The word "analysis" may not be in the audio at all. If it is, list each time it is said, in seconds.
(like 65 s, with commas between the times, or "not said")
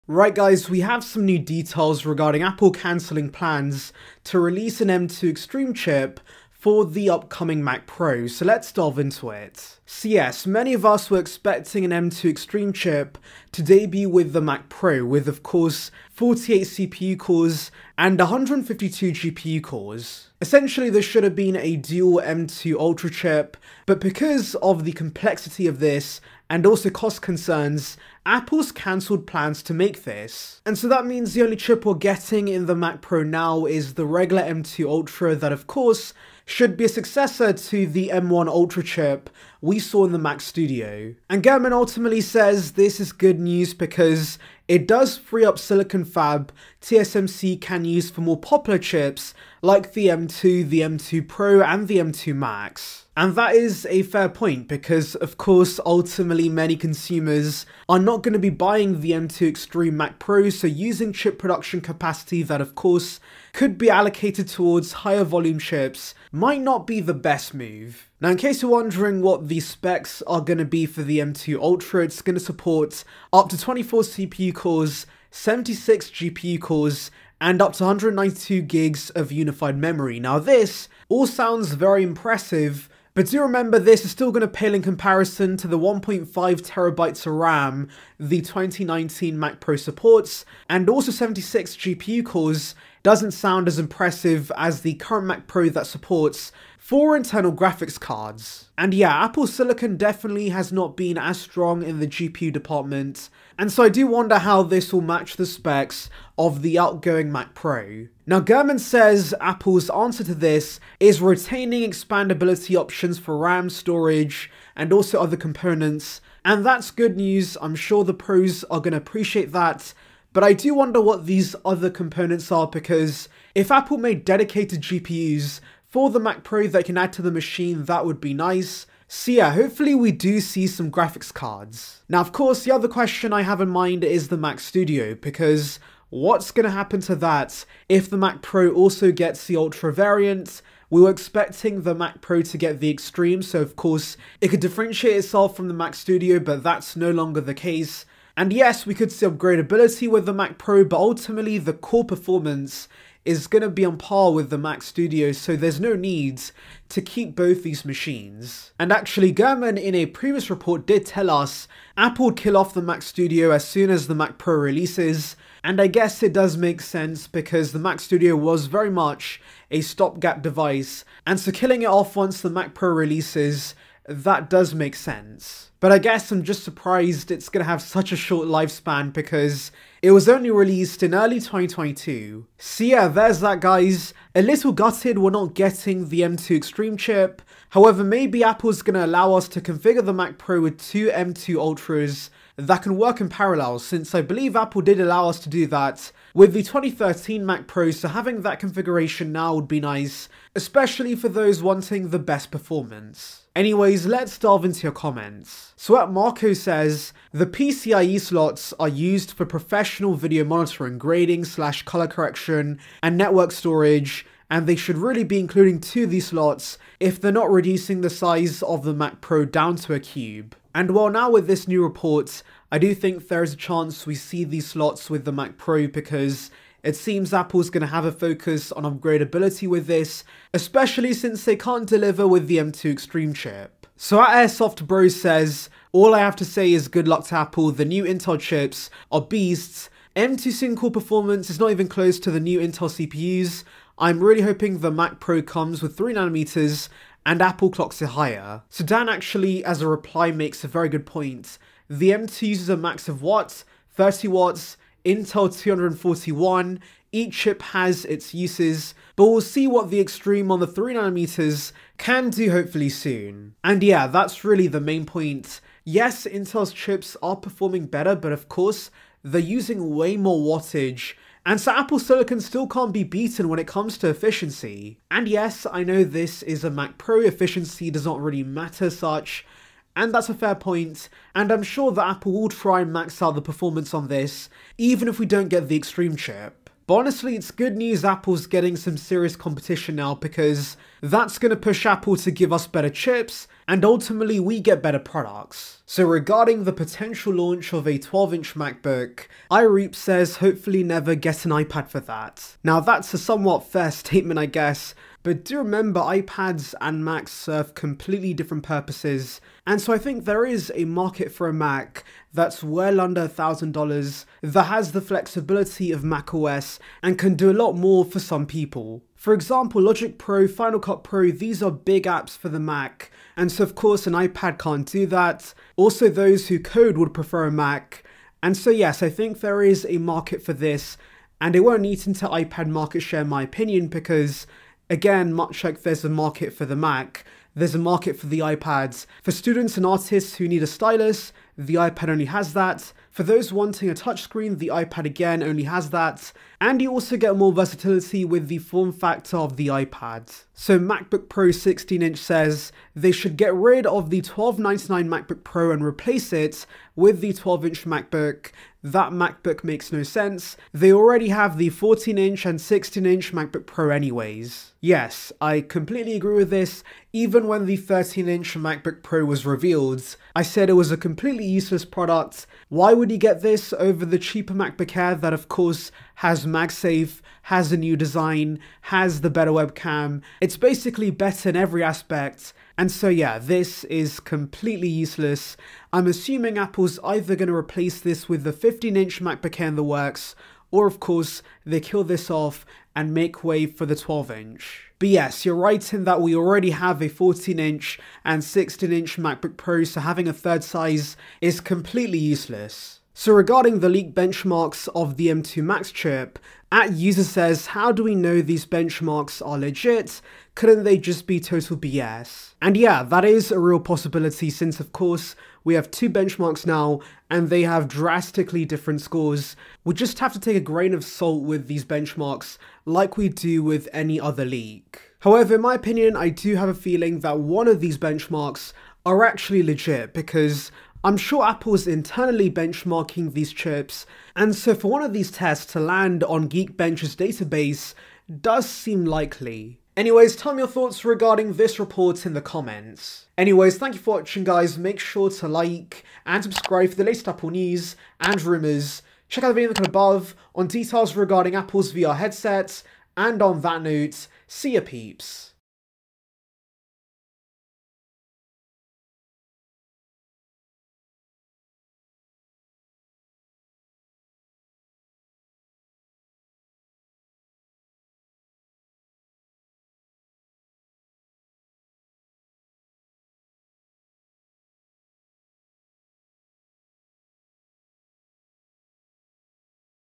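not said.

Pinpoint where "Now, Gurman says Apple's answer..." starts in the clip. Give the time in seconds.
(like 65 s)
108 s.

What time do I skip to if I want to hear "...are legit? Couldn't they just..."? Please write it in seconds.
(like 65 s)
409 s.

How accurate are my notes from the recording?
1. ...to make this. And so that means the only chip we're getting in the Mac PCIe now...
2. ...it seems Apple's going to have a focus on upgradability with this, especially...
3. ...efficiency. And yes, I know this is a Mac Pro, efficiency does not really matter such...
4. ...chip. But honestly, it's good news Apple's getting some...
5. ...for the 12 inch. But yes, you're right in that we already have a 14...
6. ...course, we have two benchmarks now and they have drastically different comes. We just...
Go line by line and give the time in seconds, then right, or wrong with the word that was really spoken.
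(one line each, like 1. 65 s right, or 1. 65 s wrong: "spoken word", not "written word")
1. 29 s wrong: "Pro", not "PCIe"
2. 226 s right
3. 274 s right
4. 286 s right
5. 393 s right
6. 414 s wrong: "scores", not "comes".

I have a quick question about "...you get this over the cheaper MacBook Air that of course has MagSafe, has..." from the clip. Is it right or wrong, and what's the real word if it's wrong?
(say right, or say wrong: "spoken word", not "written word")
right.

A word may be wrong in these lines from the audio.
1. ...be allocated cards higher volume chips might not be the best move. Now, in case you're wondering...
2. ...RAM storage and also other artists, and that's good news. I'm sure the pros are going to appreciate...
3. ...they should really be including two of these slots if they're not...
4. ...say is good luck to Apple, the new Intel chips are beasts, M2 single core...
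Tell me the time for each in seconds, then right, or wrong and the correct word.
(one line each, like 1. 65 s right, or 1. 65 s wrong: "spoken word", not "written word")
1. 63 s wrong: "towards", not "cards"
2. 113 s wrong: "components", not "artists"
3. 214 s right
4. 236 s right.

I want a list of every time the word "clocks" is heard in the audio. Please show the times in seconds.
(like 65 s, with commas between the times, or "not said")
247 s.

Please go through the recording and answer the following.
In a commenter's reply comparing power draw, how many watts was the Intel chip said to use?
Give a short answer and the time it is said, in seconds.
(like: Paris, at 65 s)
241, at 255 s.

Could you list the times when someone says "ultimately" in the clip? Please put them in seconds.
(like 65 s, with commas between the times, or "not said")
41 s, 55 s, 150 s, 293 s.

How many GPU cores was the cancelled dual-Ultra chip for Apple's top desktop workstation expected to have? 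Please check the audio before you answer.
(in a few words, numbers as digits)
152.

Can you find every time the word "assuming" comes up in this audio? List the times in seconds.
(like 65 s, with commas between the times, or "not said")
386 s.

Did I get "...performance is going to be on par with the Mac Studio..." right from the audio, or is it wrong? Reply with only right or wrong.
right.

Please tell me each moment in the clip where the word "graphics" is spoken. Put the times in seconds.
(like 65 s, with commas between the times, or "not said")
97 s, 130 s.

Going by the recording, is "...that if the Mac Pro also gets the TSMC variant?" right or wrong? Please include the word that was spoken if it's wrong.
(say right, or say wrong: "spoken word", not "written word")
wrong: "Ultra", not "TSMC".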